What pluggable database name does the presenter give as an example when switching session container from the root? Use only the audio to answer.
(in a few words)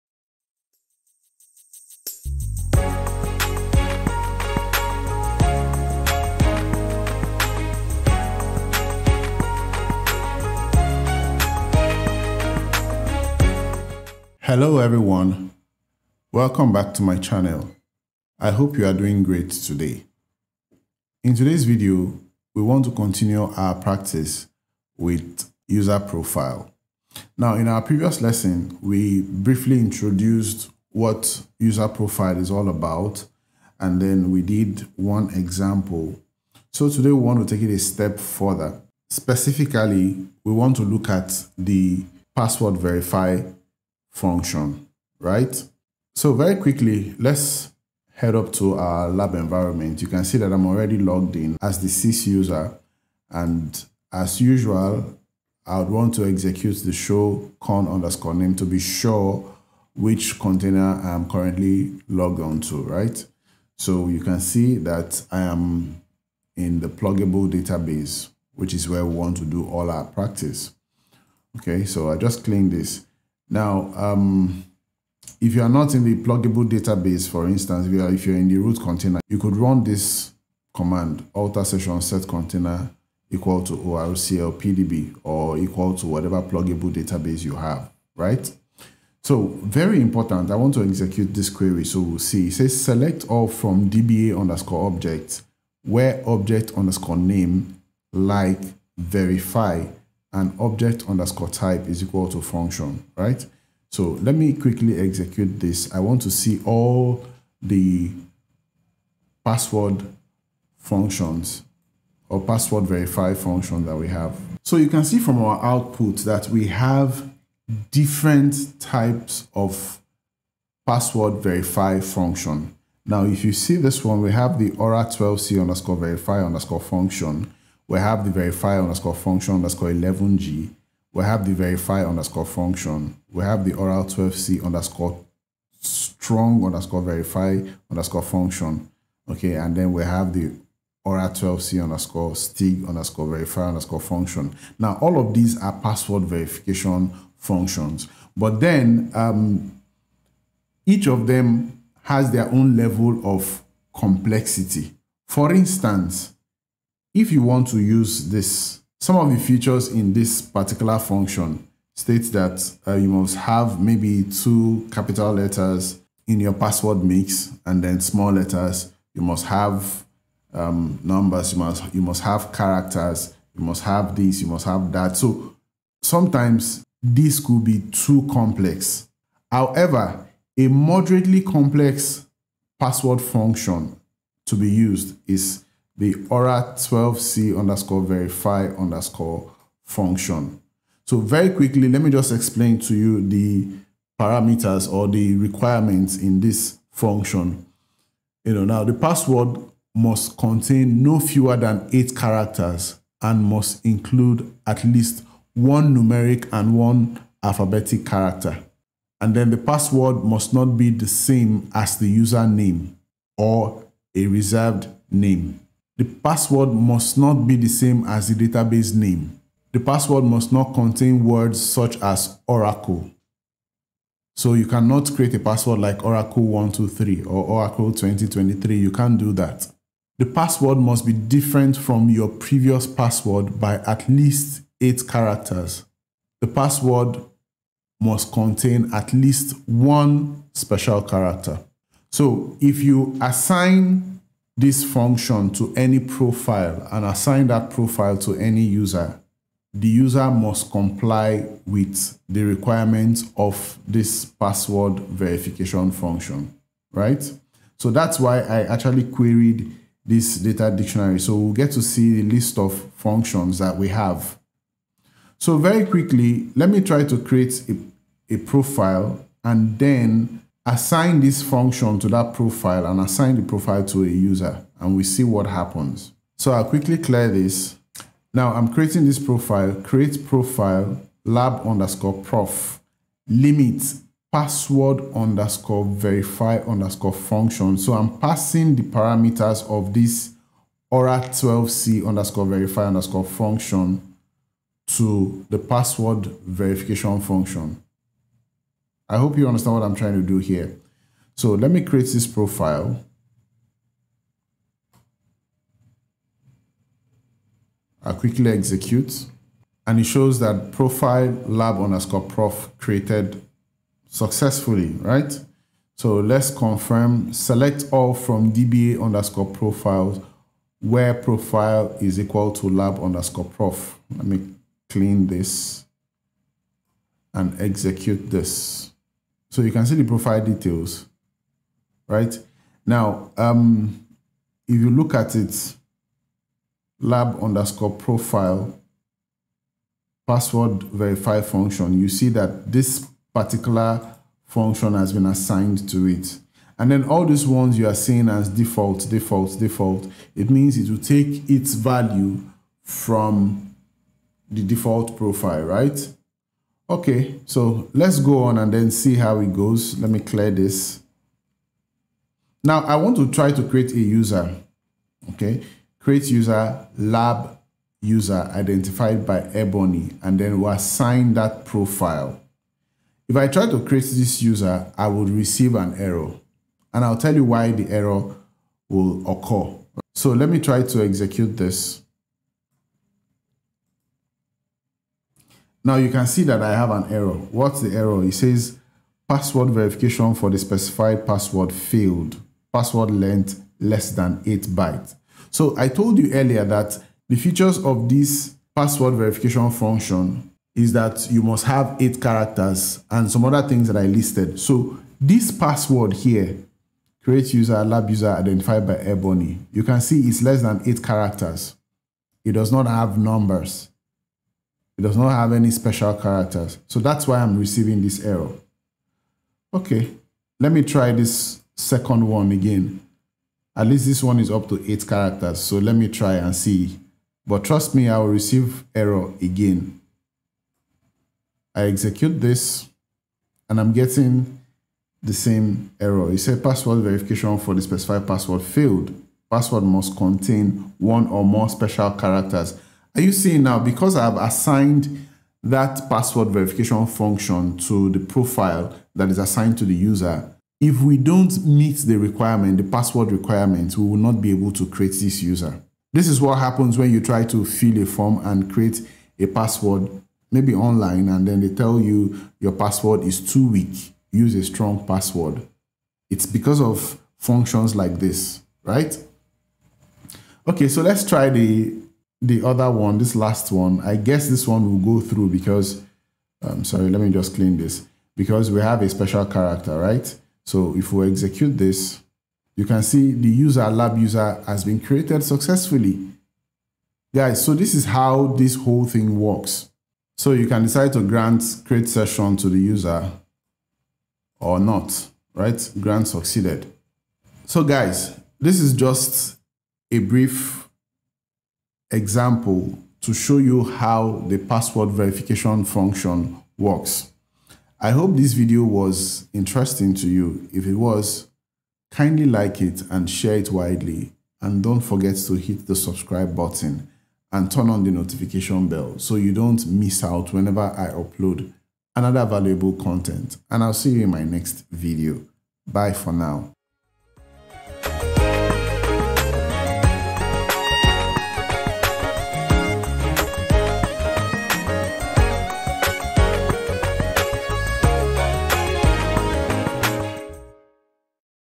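ORCL PDB.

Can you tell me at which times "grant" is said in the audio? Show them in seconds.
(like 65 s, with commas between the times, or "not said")
491 s, 495 s.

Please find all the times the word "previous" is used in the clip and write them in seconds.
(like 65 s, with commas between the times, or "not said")
27 s, 232 s.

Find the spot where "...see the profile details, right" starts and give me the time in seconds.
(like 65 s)
329 s.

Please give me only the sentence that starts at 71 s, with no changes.
Okay, so I just clean this.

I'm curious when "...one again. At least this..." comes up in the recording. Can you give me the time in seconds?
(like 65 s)
422 s.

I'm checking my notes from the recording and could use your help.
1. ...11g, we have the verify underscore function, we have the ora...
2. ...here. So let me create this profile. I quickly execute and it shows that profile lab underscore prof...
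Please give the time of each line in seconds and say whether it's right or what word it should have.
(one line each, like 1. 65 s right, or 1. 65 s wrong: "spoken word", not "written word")
1. 129 s right
2. 300 s right.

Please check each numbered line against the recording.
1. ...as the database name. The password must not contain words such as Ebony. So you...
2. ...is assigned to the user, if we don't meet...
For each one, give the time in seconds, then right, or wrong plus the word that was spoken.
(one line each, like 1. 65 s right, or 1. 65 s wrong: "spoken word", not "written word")
1. 218 s wrong: "Oracle", not "Ebony"
2. 449 s right.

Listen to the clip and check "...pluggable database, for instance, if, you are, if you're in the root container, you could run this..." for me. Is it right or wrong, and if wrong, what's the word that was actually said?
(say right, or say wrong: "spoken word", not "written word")
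right.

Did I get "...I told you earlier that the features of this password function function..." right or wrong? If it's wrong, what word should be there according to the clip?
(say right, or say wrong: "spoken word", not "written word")
wrong: "verification", not "function".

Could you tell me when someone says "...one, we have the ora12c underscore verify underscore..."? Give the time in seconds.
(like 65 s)
124 s.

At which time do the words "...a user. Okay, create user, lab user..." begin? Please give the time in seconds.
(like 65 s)
363 s.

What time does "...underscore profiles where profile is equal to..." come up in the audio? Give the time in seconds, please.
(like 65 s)
319 s.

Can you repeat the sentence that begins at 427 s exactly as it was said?
But trust me, I will receive error again.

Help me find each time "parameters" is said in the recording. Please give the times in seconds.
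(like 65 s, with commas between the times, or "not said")
194 s, 288 s.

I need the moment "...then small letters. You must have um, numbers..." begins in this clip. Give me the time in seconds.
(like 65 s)
167 s.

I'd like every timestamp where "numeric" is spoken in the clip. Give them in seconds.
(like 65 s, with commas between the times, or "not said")
205 s.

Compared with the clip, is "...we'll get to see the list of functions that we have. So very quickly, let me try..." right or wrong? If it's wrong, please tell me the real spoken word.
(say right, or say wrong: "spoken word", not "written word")
right.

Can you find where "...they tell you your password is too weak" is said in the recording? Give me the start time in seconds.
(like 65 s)
461 s.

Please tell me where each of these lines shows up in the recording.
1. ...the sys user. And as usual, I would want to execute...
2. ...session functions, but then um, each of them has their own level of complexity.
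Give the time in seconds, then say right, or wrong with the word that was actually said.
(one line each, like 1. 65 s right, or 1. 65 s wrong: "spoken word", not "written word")
1. 51 s right
2. 146 s wrong: "verification", not "session".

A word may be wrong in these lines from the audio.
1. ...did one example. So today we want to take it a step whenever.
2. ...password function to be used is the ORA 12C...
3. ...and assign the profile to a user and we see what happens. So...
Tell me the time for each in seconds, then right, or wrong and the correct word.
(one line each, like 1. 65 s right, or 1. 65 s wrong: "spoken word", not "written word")
1. 34 s wrong: "further", not "whenever"
2. 182 s right
3. 272 s right.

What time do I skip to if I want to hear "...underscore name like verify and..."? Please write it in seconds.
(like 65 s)
96 s.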